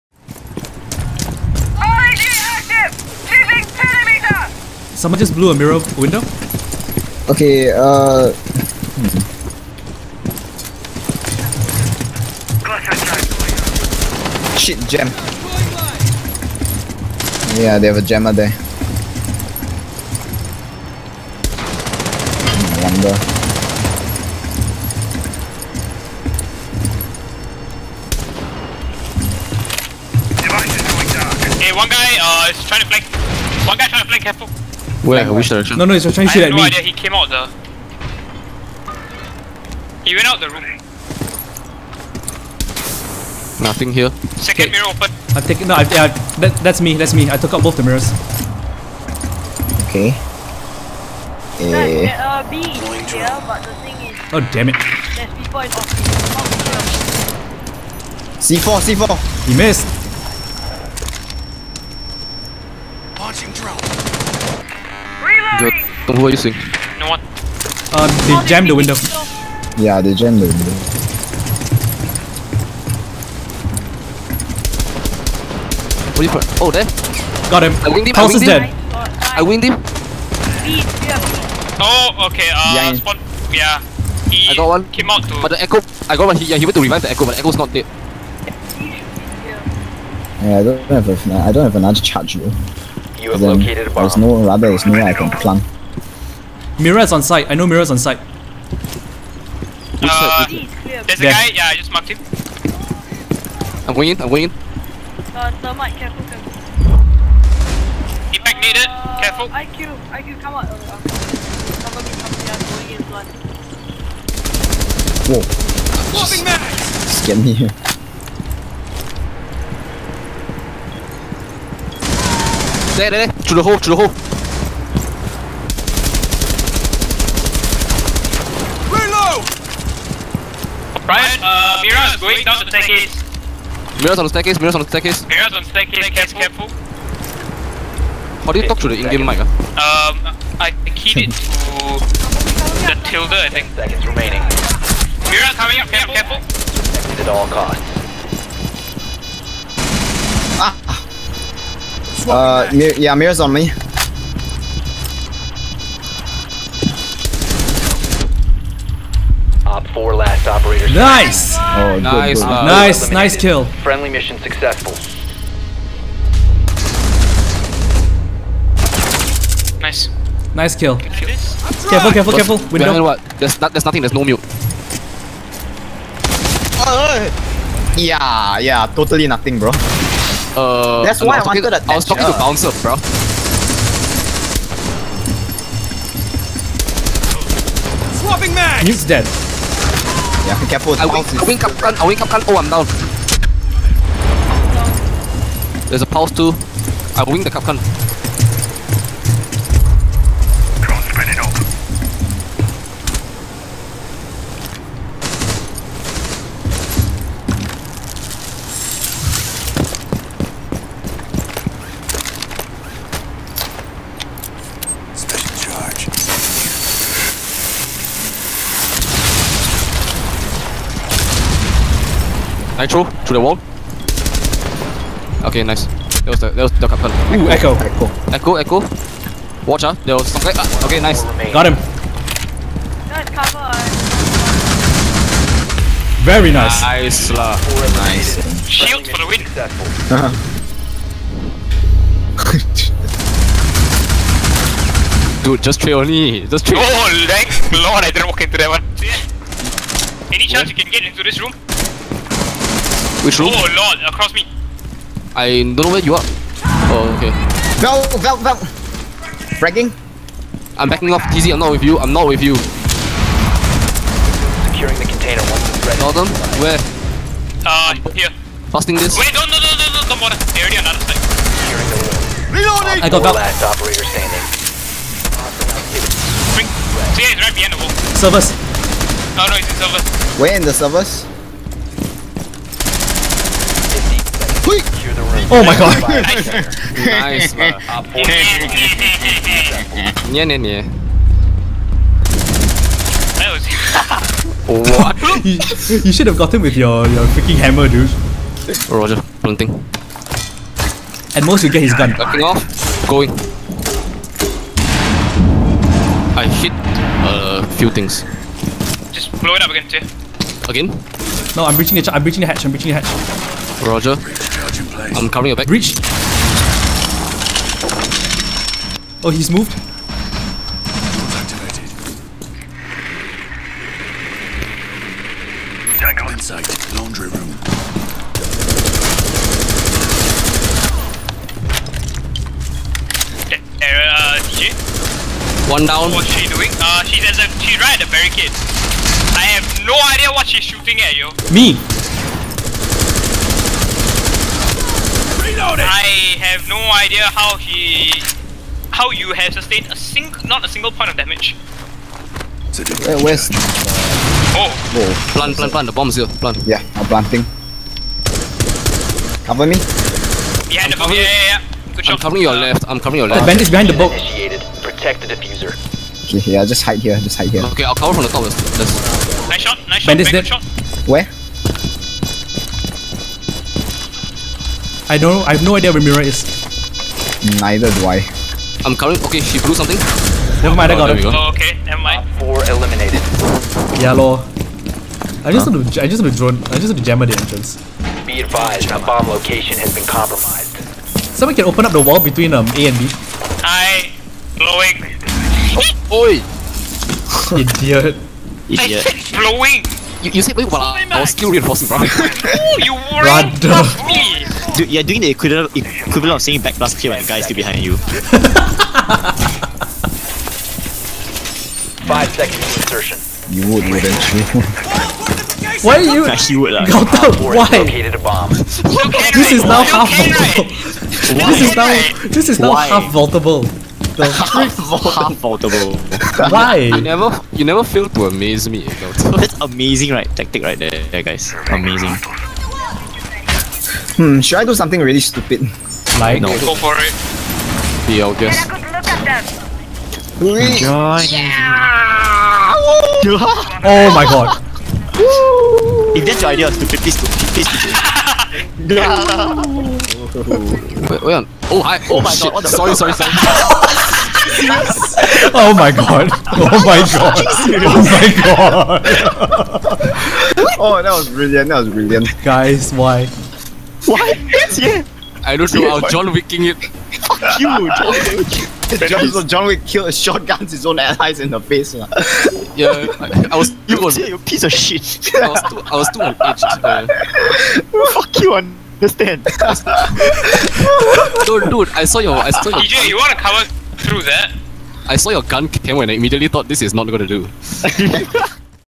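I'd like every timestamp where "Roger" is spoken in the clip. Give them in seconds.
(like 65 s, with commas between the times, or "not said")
298 s, 313 s.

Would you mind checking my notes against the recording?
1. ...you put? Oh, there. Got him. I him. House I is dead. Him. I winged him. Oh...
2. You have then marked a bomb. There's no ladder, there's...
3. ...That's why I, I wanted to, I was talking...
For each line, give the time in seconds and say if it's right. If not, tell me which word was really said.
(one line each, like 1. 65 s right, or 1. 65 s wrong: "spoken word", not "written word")
1. 76 s right
2. 93 s wrong: "located", not "marked"
3. 181 s right.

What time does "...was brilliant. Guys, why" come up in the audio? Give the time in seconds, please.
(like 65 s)
461 s.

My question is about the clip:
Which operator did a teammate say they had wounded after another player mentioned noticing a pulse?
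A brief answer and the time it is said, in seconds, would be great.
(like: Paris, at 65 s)
Capcom, at 197 s.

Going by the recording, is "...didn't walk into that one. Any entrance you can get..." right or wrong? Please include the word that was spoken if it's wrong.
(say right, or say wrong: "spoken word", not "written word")
wrong: "chance", not "entrance".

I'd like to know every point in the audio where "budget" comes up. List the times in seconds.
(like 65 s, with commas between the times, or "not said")
not said.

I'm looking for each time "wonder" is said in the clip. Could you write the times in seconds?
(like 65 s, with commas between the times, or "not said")
22 s.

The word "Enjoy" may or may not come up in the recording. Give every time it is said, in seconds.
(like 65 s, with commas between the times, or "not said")
440 s.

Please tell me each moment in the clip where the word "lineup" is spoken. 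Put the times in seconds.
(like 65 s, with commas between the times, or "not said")
not said.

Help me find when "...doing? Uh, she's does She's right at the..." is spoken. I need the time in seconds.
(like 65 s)
336 s.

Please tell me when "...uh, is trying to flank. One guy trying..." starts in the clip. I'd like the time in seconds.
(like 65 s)
32 s.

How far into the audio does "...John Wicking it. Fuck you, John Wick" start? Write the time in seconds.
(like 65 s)
466 s.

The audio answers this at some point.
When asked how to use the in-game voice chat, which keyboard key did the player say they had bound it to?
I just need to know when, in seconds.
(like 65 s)
143 s.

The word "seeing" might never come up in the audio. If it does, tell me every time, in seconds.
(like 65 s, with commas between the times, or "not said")
66 s.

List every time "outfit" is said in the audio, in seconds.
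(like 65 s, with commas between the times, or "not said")
not said.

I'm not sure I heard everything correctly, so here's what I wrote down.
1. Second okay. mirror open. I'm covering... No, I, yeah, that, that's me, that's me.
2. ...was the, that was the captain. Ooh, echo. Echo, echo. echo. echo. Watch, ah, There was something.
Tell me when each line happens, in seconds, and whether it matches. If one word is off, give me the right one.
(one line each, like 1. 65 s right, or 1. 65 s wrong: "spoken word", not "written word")
1. 44 s wrong: "taking", not "covering"
2. 226 s right.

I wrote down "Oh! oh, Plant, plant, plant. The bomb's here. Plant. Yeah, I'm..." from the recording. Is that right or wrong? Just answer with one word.
right.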